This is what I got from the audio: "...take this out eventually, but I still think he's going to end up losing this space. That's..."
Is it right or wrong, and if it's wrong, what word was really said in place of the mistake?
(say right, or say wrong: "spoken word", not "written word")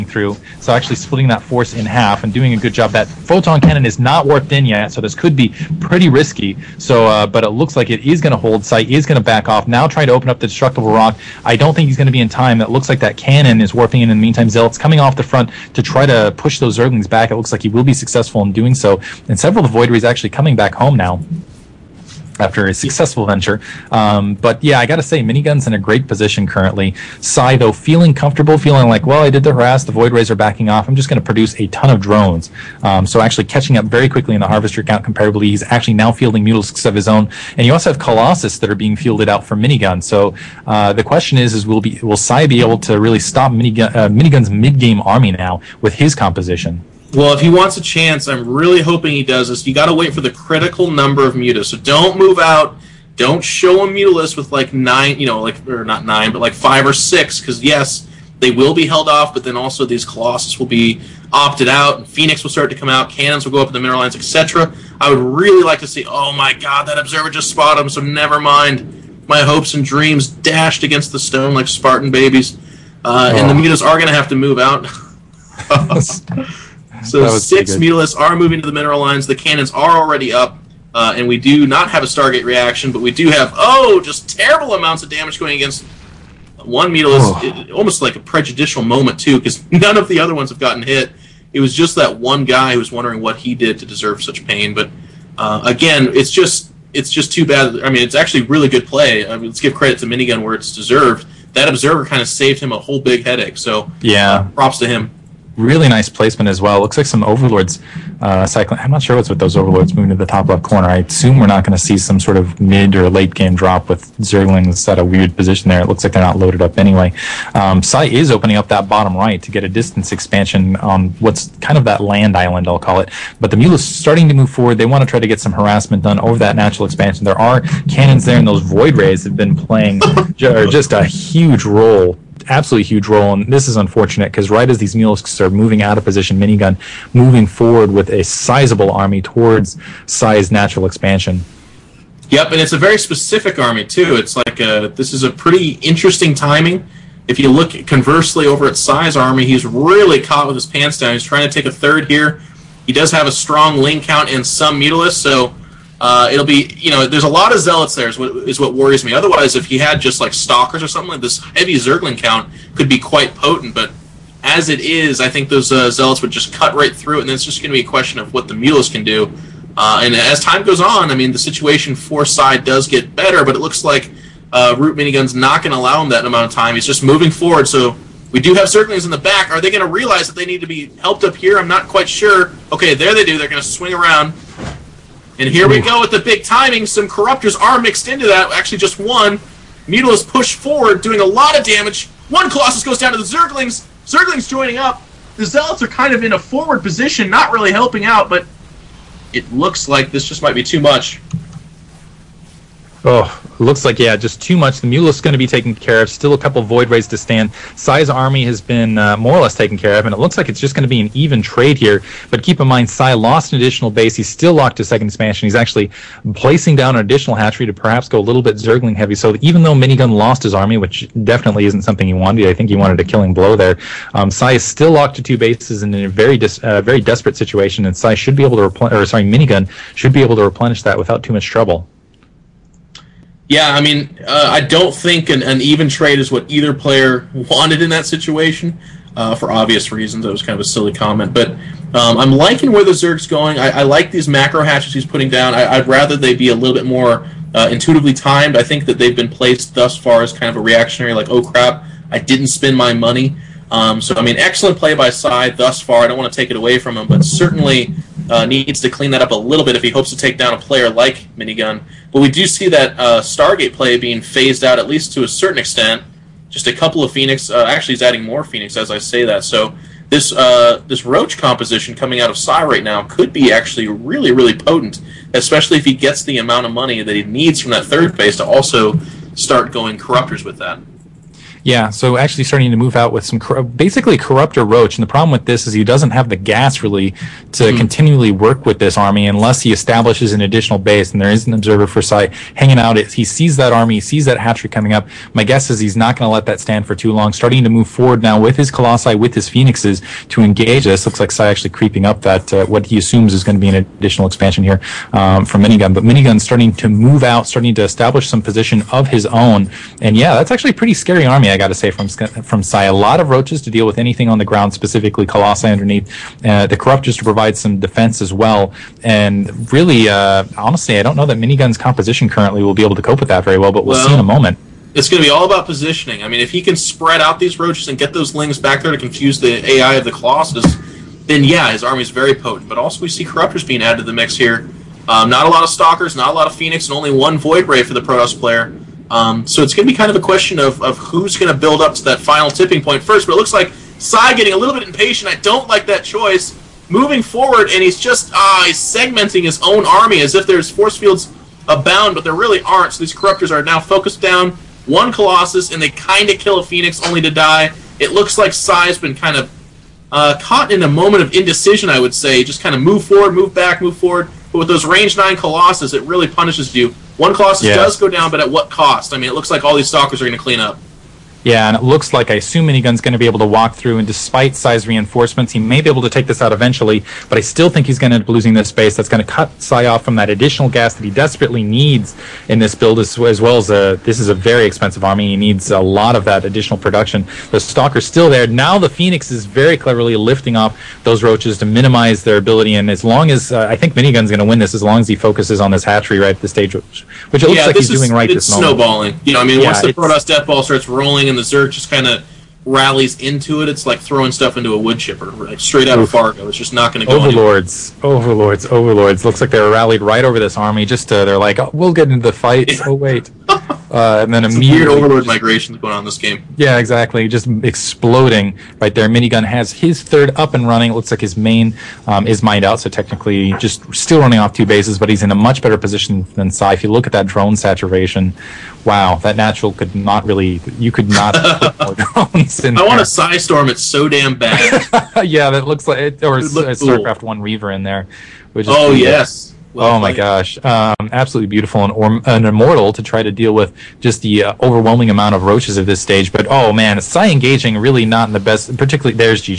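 right.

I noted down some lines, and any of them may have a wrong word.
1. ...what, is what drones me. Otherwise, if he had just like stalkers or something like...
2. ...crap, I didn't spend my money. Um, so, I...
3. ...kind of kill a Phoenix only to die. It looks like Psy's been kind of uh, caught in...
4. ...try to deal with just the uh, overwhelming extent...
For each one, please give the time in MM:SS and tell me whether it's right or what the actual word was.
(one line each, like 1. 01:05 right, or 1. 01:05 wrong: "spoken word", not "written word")
1. 02:38 wrong: "worries", not "drones"
2. 04:11 right
3. 05:55 right
4. 07:23 wrong: "amount", not "extent".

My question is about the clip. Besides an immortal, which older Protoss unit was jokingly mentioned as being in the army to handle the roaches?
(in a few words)
Reaver.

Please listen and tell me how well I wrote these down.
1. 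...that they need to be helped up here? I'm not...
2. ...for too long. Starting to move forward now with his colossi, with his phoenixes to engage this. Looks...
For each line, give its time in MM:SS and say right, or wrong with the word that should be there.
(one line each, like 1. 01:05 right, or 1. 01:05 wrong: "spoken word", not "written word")
1. 03:00 right
2. 04:56 right.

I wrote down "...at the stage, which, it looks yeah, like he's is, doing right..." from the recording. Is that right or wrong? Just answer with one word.
right.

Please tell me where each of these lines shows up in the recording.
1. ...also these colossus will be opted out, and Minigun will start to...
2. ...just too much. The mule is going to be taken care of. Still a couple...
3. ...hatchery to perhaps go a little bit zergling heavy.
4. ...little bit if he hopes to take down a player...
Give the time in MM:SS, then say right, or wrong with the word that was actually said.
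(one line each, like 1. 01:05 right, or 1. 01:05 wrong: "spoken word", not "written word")
1. 00:59 wrong: "Phoenix", not "Minigun"
2. 03:24 right
3. 03:37 right
4. 04:19 right.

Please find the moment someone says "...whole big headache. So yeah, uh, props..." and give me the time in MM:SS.
01:42.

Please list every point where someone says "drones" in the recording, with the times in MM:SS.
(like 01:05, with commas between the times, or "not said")
00:32, 07:07, 07:11.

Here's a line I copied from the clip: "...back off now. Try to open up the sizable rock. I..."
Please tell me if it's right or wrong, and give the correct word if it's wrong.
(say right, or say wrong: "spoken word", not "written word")
wrong: "destructible", not "sizable".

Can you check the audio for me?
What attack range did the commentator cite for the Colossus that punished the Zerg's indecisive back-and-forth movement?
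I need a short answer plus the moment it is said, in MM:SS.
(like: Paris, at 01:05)
9, at 06:04.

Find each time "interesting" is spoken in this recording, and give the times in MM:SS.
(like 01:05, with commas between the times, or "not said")
02:25.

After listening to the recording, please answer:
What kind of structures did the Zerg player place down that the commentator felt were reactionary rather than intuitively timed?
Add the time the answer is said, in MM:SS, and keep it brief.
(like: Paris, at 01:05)
Macro hatches, at 04:04.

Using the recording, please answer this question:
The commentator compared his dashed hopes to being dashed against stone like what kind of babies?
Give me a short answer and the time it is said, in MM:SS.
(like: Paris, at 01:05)
Spartan babies, at 01:11.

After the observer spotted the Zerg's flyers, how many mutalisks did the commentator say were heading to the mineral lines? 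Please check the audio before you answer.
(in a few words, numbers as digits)
6.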